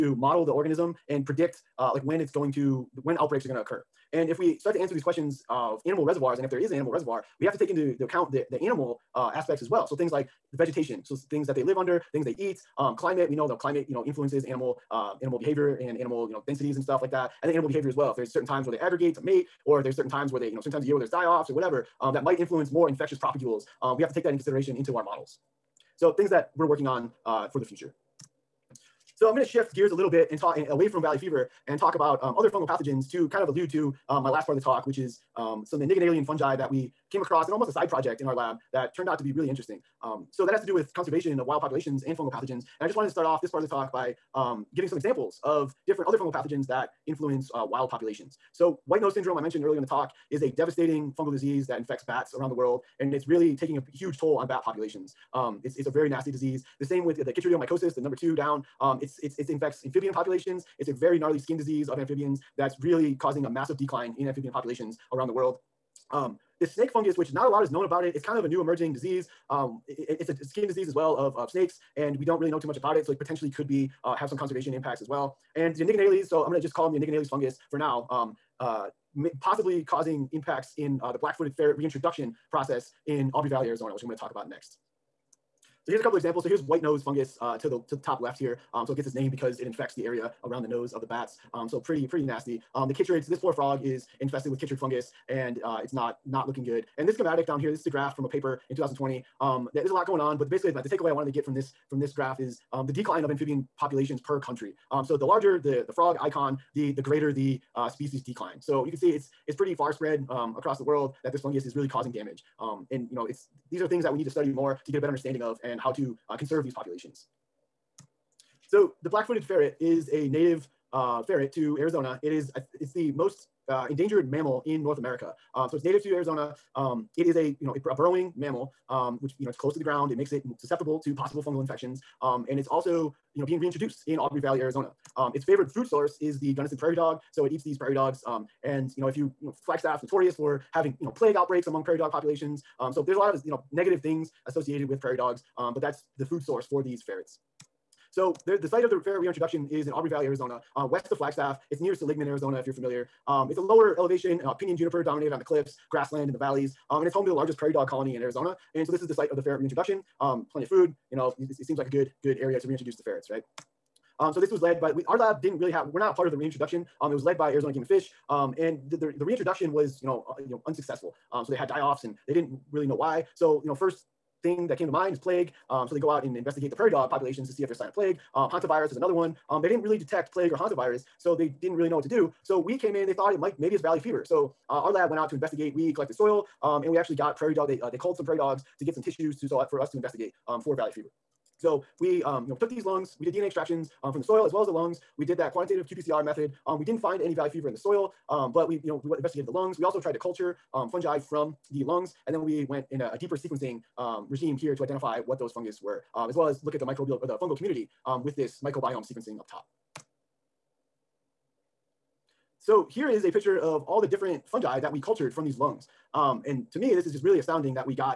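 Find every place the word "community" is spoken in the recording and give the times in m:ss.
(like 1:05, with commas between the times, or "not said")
3:27.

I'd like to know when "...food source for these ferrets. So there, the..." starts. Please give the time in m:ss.
2:26.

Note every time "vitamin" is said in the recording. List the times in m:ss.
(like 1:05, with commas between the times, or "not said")
not said.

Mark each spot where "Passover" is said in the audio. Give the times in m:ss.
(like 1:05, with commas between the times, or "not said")
not said.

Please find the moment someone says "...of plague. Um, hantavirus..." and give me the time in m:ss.
2:57.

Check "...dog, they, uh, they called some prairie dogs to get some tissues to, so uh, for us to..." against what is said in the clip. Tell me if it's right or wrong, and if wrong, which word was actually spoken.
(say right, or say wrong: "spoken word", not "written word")
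right.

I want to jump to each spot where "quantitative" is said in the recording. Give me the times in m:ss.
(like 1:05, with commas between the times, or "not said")
3:15.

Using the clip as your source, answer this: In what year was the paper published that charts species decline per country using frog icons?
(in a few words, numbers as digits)
2020.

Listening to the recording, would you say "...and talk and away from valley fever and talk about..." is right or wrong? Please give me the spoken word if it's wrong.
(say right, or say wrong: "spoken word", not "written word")
right.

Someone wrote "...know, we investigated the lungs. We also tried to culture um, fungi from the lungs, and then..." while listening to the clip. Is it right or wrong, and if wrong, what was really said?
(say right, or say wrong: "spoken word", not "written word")
right.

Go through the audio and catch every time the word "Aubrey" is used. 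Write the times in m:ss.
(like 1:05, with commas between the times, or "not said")
1:23, 2:14, 2:29.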